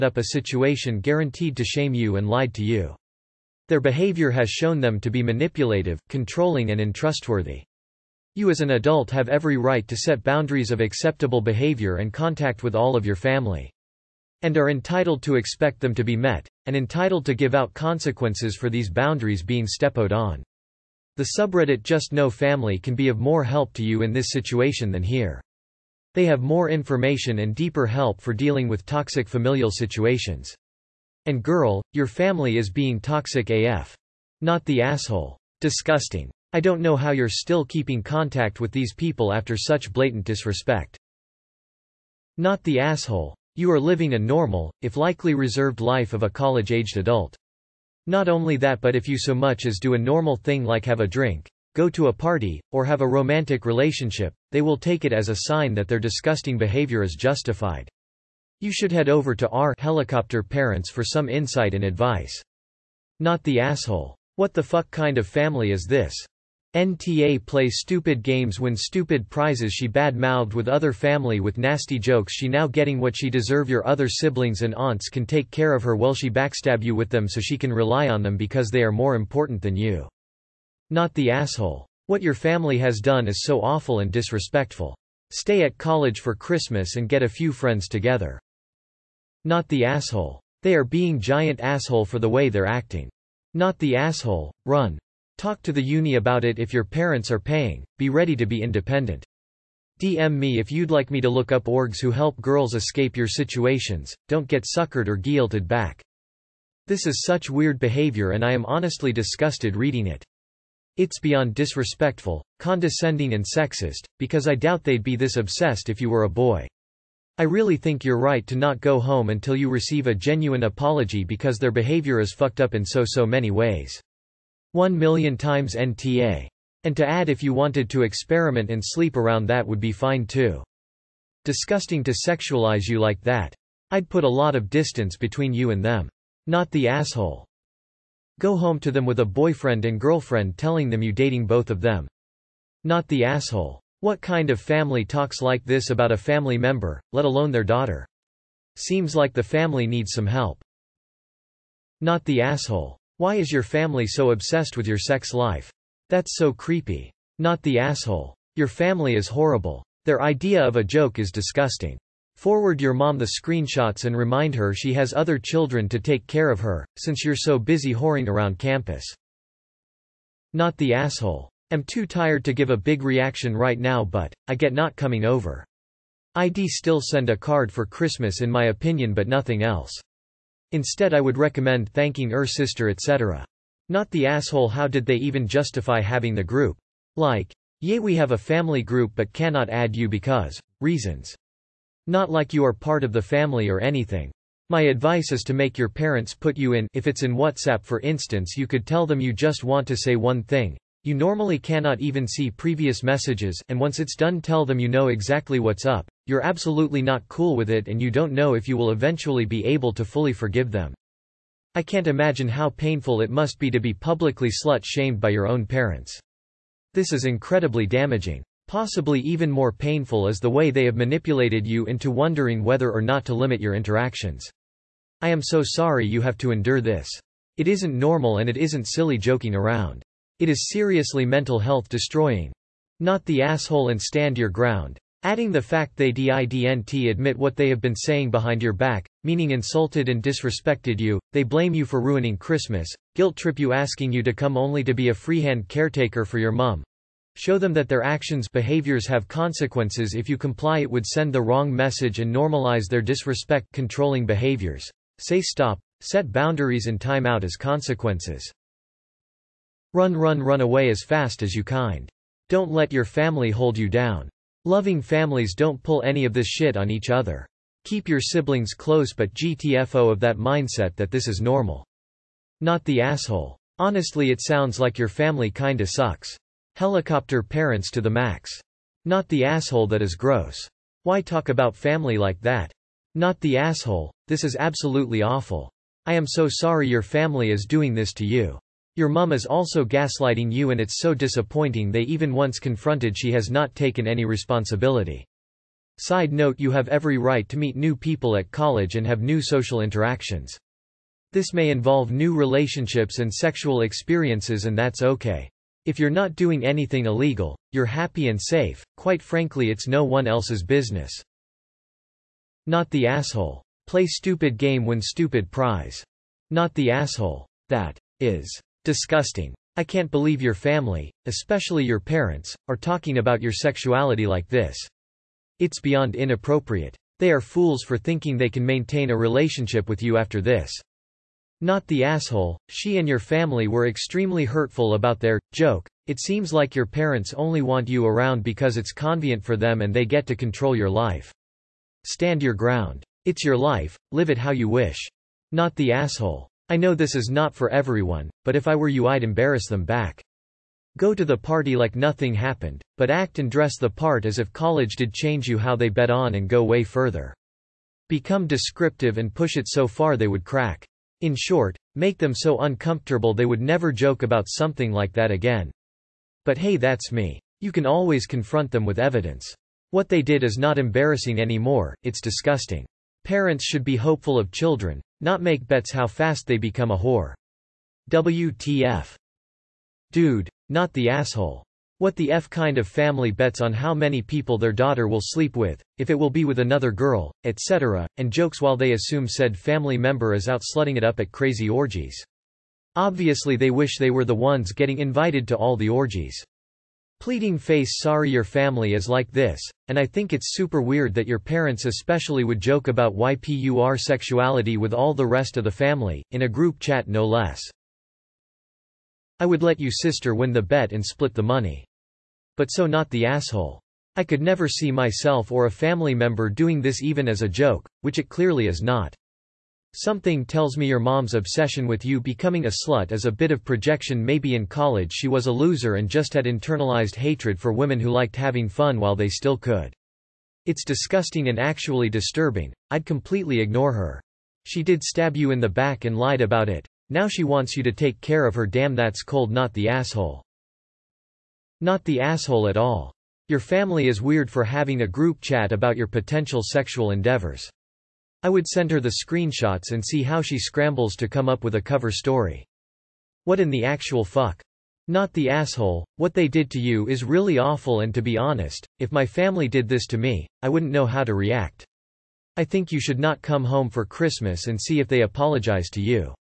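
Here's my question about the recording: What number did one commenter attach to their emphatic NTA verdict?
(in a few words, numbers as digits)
1 million.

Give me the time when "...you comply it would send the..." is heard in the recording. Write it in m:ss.
4:10.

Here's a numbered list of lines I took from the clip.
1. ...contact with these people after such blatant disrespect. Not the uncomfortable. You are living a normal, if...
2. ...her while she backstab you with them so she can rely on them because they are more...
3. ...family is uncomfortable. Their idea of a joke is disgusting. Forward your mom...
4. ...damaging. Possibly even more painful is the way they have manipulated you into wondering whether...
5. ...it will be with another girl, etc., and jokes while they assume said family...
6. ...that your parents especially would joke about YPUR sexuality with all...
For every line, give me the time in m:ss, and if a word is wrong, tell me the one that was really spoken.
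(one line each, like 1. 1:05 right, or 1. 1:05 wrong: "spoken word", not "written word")
1. 0:38 wrong: "asshole", not "uncomfortable"
2. 1:15 right
3. 2:38 wrong: "horrible", not "uncomfortable"
4. 3:37 right
5. 6:26 right
6. 6:41 right.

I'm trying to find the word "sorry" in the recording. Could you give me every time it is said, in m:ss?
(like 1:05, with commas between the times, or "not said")
3:45, 4:46, 6:37.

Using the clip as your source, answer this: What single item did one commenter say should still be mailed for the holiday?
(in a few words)
a card.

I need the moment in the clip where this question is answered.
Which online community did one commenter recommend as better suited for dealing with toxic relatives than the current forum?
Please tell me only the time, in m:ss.
0:21.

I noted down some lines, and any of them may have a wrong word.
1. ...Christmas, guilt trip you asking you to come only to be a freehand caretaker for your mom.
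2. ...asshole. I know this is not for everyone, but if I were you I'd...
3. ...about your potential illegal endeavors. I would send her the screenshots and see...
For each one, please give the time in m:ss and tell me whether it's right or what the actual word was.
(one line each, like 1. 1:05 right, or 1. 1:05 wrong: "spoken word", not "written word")
1. 4:02 right
2. 5:45 right
3. 7:25 wrong: "sexual", not "illegal".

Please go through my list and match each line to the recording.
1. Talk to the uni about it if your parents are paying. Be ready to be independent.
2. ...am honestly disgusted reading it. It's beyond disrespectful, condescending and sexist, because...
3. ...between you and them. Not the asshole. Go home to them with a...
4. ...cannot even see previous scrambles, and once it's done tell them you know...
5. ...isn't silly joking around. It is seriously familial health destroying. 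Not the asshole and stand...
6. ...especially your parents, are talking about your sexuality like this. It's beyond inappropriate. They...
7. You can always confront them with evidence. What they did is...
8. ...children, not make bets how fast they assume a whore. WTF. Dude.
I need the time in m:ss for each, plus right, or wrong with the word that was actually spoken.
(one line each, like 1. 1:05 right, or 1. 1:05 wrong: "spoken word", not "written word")
1. 1:35 right
2. 1:48 right
3. 2:15 right
4. 3:21 wrong: "messages", not "scrambles"
5. 3:48 wrong: "mental", not "familial"
6. 5:21 right
7. 6:07 right
8. 6:14 wrong: "become", not "assume".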